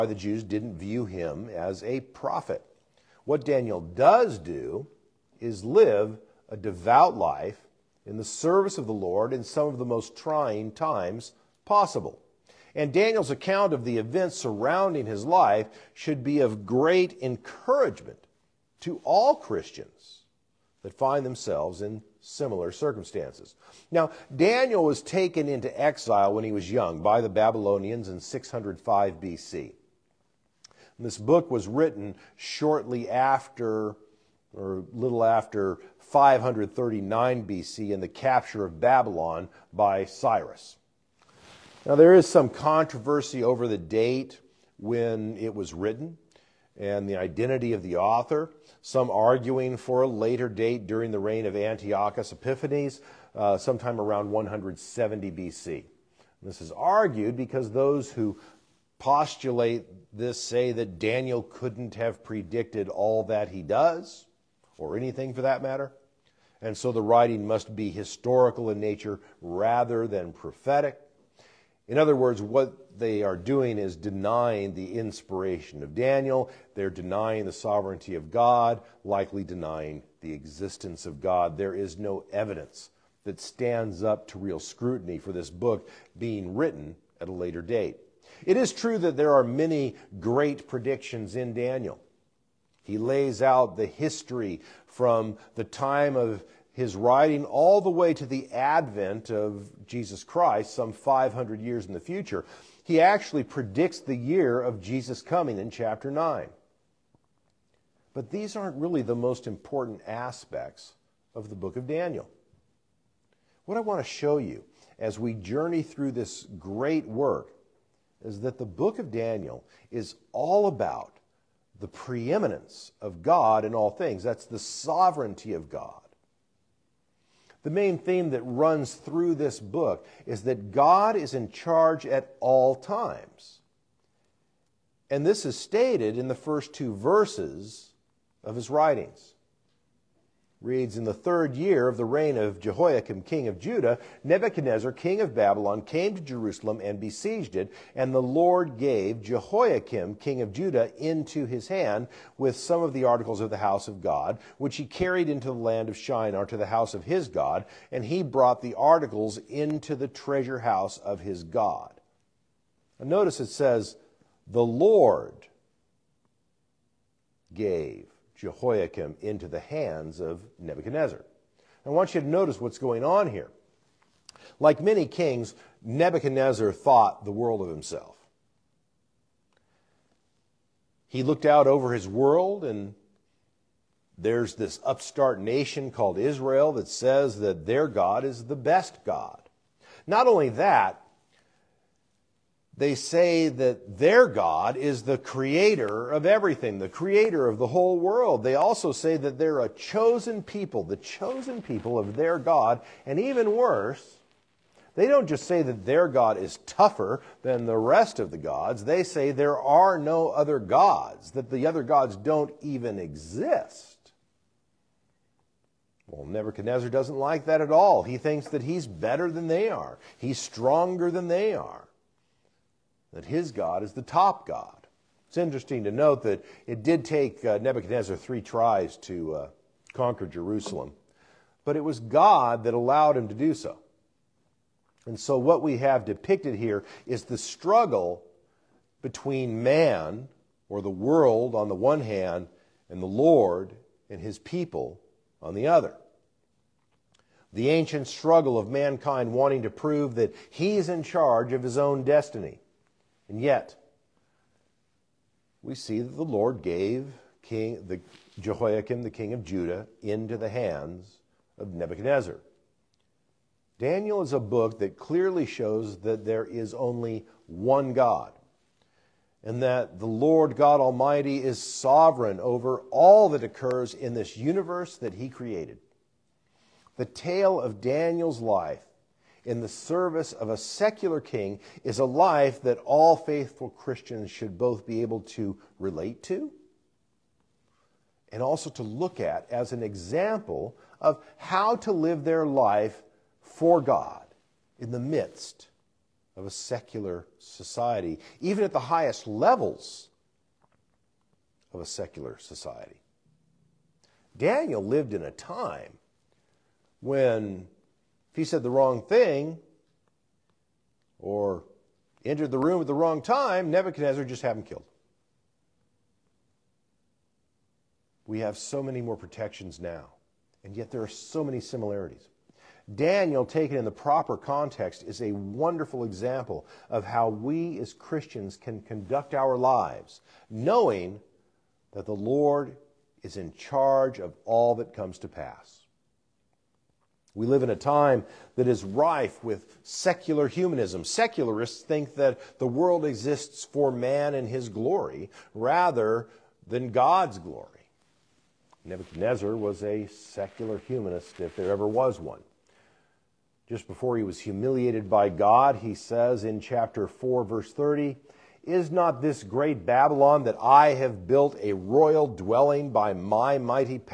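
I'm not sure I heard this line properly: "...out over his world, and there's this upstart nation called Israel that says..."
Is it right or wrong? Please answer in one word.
right.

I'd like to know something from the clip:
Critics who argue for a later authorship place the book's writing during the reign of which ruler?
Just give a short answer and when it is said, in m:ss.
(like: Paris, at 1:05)
Antiochus Epiphanes, at 0:51.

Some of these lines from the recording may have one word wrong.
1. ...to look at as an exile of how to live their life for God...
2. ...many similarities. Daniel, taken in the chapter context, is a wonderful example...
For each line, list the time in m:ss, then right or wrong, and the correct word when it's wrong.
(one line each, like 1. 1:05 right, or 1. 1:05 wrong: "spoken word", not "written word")
1. 4:48 wrong: "example", not "exile"
2. 5:21 wrong: "proper", not "chapter".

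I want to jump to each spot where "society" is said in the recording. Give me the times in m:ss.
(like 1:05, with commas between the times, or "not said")
4:57, 5:02.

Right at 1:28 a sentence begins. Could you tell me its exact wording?
It is true that there are many great predictions in Daniel.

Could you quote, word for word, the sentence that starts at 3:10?
Not only that, they say that their God is the creator of everything, the creator of the whole world.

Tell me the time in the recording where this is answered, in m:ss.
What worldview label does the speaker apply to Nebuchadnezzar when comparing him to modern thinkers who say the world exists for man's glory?
5:50.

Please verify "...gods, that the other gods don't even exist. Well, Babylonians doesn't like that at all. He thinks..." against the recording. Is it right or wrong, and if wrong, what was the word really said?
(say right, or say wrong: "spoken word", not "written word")
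wrong: "Nebuchadnezzar", not "Babylonians".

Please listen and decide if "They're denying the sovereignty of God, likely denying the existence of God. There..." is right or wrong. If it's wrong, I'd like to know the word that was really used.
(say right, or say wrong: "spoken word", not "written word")
right.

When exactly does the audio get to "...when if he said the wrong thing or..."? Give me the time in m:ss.
5:07.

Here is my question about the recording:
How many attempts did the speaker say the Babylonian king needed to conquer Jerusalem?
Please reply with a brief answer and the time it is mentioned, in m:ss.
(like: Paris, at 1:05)
3, at 3:48.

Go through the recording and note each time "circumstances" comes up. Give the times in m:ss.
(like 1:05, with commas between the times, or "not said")
0:22.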